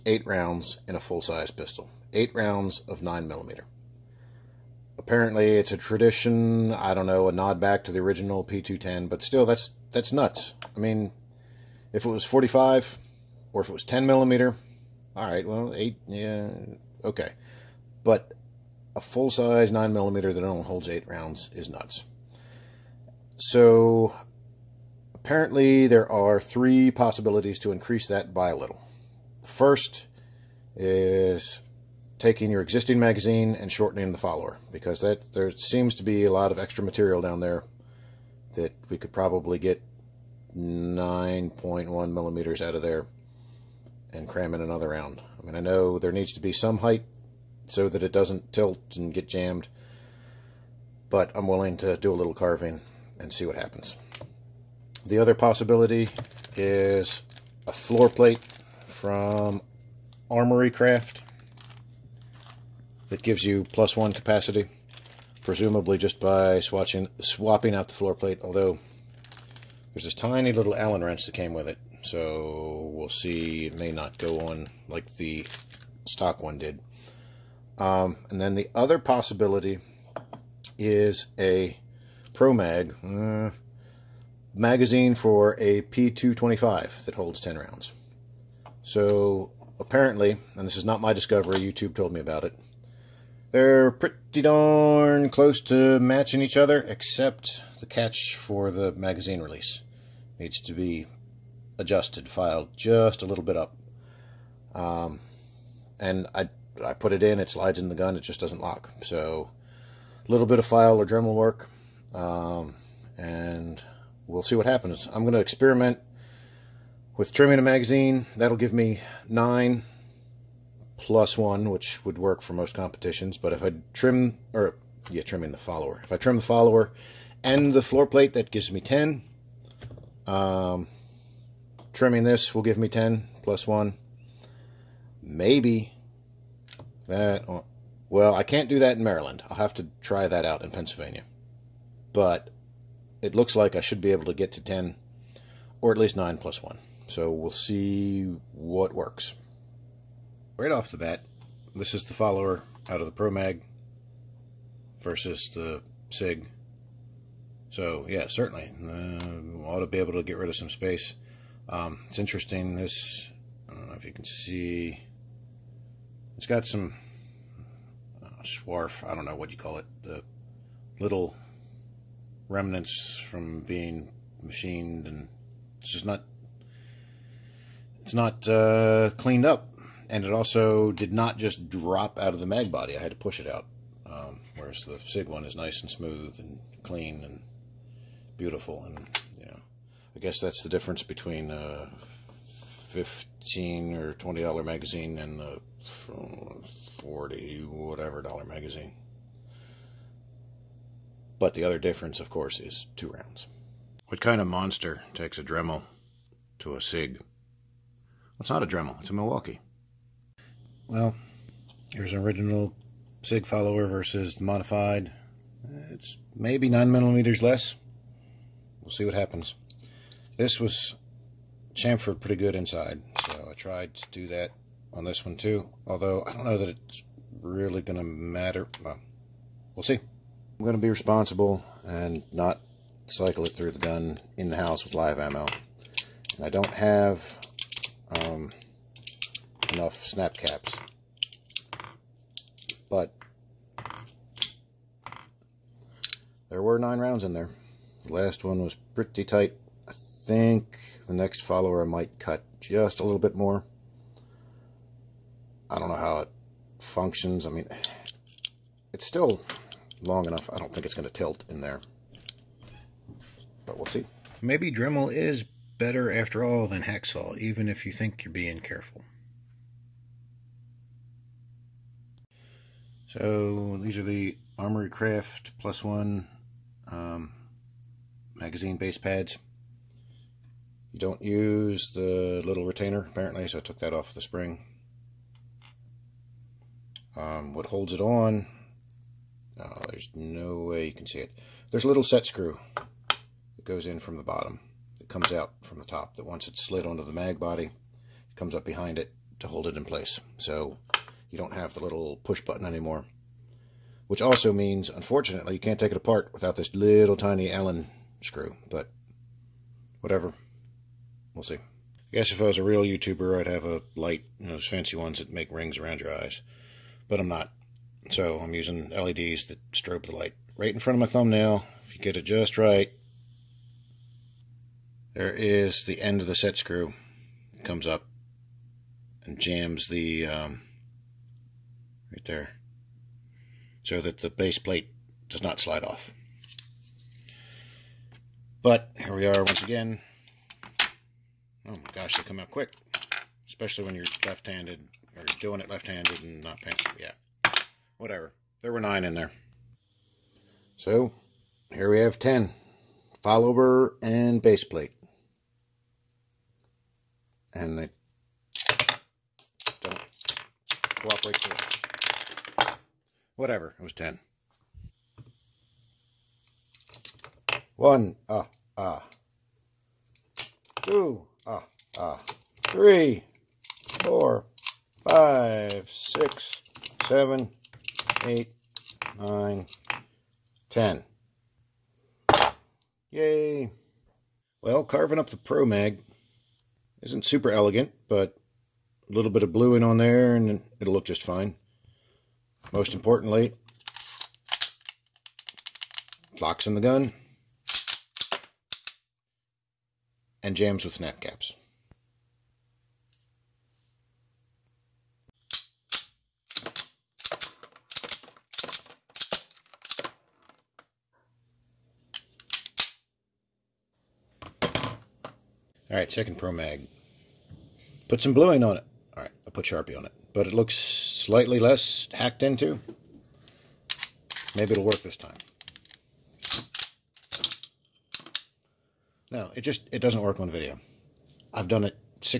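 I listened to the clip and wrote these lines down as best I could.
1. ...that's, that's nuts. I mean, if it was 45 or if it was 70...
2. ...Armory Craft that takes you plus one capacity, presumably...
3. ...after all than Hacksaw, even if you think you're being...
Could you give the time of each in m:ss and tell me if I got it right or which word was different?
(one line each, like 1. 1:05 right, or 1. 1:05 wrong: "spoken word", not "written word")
1. 0:09 wrong: "10", not "70"
2. 1:00 wrong: "gives", not "takes"
3. 4:26 right.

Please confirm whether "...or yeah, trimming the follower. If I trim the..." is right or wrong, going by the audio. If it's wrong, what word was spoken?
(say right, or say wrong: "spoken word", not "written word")
right.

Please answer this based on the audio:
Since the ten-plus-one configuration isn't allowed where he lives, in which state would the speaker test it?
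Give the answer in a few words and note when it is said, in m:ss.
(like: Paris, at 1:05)
Pennsylvania, at 2:20.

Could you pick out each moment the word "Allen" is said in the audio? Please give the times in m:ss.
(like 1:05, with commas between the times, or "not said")
1:10, 5:07.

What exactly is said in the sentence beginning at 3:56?
And I don't have um, enough snap caps.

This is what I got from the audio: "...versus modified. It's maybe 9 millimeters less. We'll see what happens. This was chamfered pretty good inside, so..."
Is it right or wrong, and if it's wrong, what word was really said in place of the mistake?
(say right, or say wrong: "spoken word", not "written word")
right.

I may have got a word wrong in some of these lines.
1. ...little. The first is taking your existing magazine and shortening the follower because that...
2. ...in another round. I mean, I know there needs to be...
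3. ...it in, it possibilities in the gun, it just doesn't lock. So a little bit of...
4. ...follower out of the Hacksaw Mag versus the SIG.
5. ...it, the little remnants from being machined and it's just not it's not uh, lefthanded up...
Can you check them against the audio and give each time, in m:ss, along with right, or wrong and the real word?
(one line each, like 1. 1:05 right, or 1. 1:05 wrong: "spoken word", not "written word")
1. 0:28 right
2. 0:44 right
3. 1:47 wrong: "slides", not "possibilities"
4. 2:32 wrong: "Pro", not "Hacksaw"
5. 2:49 wrong: "cleaned", not "lefthanded".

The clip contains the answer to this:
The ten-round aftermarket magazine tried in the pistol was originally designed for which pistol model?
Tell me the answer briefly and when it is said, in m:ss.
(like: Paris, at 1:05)
P225, at 1:25.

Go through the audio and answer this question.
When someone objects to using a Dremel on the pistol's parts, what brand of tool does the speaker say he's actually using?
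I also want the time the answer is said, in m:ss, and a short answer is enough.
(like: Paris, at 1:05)
Milwaukee, at 3:29.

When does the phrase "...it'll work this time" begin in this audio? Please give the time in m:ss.
7:04.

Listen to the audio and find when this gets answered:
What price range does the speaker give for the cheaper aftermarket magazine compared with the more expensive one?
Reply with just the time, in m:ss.
3:12.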